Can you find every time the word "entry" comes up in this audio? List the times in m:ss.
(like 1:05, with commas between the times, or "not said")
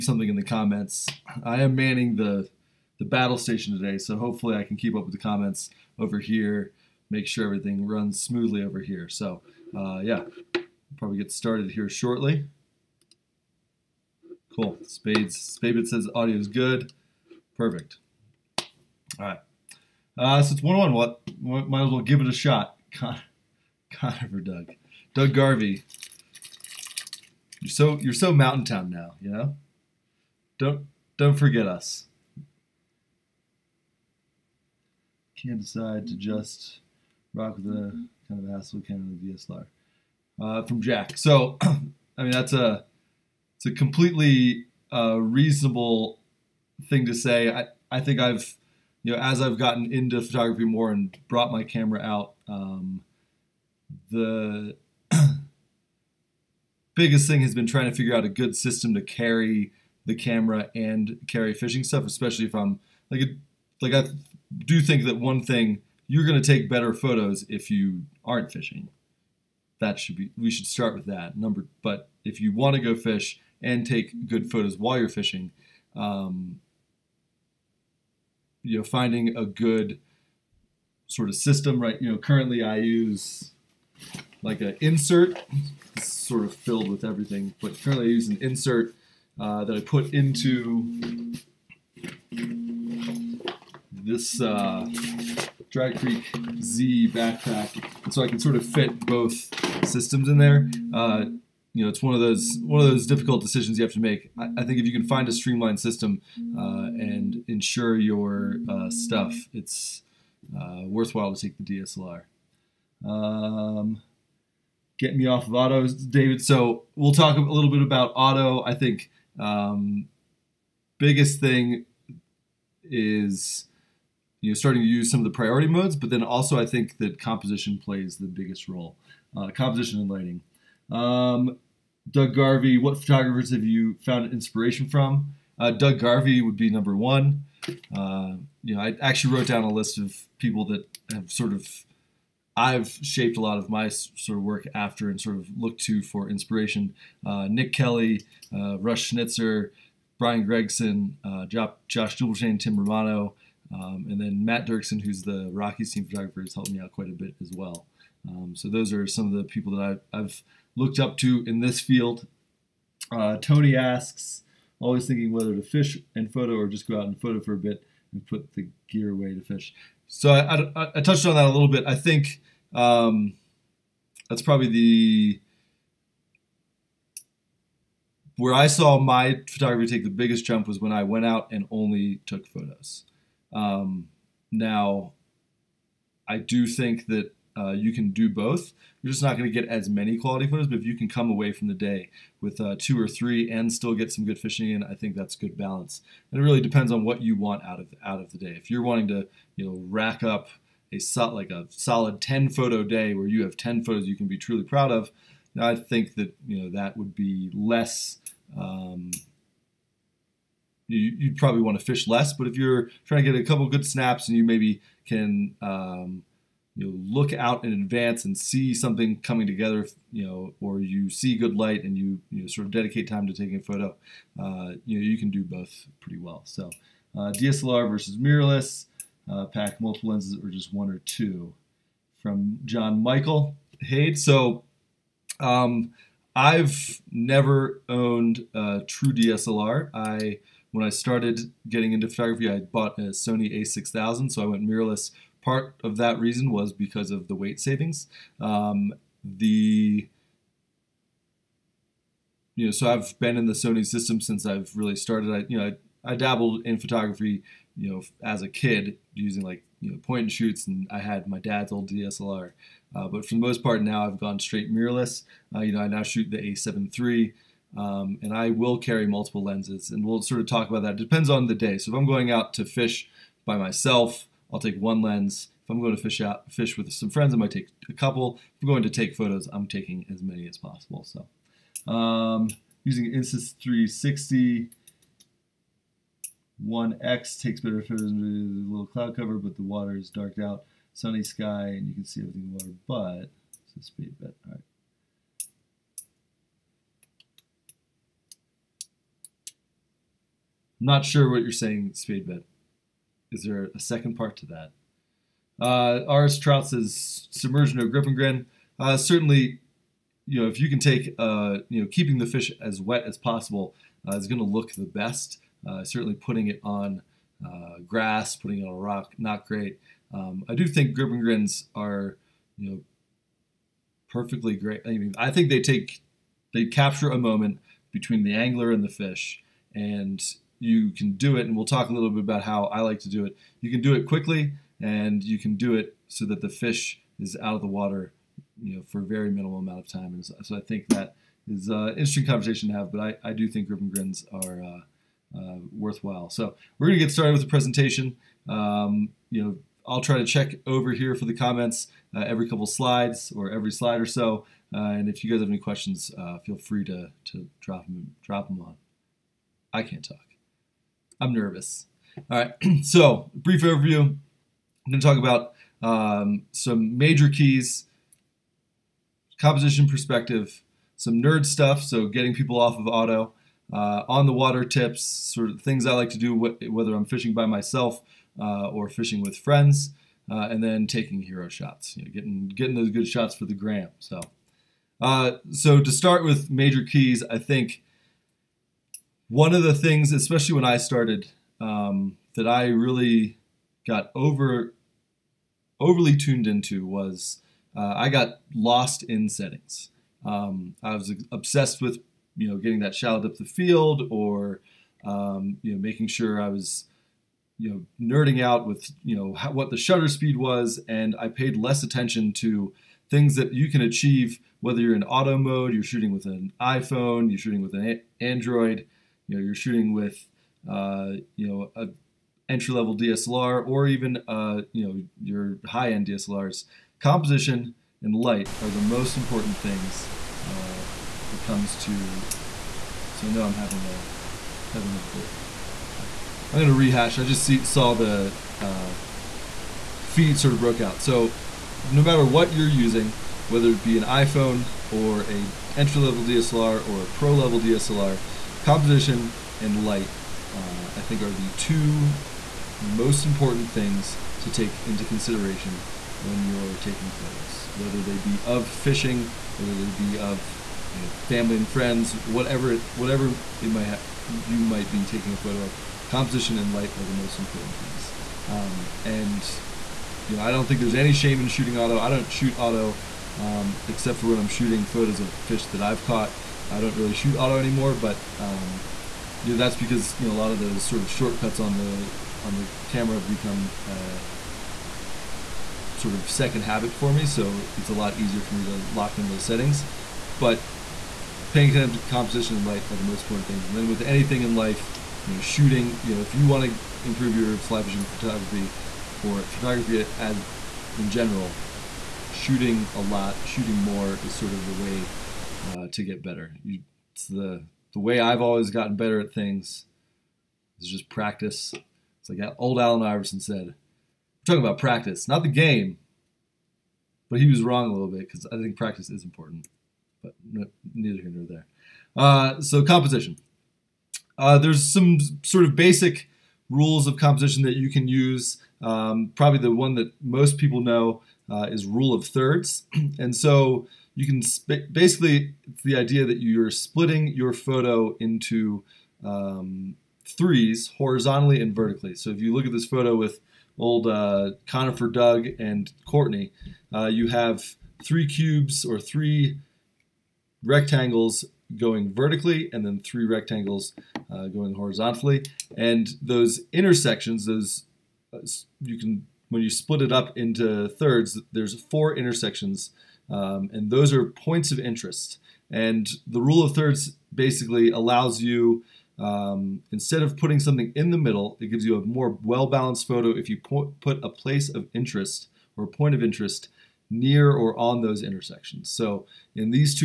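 7:02, 7:25.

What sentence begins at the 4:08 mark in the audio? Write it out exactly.
Um, the you know, so I've been in the Sony system since I've really started.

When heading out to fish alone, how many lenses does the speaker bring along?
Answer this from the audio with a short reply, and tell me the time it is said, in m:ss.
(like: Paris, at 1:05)
1, at 4:34.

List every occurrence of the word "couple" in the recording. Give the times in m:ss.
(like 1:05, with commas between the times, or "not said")
3:33, 4:37, 5:52.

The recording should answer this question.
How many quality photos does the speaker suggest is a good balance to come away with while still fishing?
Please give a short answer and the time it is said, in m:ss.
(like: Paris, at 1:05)
2 or 3, at 3:12.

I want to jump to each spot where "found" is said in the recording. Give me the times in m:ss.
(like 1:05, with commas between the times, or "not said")
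2:14.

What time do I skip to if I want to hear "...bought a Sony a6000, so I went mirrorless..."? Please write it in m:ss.
4:02.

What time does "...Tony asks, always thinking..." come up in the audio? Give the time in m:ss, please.
2:43.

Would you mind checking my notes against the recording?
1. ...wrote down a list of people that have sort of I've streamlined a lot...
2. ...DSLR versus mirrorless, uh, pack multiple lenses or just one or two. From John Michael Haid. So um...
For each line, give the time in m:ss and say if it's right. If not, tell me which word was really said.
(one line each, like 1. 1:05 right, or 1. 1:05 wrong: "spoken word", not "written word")
1. 2:19 wrong: "shaped", not "streamlined"
2. 3:47 right.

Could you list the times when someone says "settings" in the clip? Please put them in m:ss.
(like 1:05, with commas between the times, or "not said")
6:39, 8:09.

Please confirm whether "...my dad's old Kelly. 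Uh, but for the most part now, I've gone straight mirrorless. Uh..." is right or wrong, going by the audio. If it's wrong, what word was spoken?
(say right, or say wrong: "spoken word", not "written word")
wrong: "DSLR", not "Kelly".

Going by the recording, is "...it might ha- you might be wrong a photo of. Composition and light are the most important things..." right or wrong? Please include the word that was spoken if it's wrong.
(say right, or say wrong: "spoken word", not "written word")
wrong: "taking", not "wrong".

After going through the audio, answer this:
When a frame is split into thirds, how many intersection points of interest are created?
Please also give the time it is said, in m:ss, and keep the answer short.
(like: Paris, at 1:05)
4, at 9:21.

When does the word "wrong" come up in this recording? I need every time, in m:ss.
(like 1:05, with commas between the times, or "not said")
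8:37.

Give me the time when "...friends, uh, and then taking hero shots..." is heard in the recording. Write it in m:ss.
6:19.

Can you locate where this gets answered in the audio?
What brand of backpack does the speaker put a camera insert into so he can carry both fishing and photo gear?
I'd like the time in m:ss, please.
1:35.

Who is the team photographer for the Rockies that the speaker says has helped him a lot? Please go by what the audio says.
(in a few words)
Matt Dirksen.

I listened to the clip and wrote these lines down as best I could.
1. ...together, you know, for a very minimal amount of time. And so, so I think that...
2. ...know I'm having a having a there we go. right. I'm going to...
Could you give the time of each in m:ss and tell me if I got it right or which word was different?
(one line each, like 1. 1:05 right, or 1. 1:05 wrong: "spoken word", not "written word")
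1. 5:37 wrong: "water", not "together"
2. 7:13 right.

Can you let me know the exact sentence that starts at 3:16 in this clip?
And it really depends on what you want out of out of the day.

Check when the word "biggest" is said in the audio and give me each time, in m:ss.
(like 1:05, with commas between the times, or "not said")
0:56, 2:00, 2:08, 3:00.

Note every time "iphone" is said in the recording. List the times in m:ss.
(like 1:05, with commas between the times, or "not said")
6:56, 7:24.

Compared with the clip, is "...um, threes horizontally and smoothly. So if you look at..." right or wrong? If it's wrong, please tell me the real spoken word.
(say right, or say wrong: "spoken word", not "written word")
wrong: "vertically", not "smoothly".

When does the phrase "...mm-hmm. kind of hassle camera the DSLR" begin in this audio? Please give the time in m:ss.
0:37.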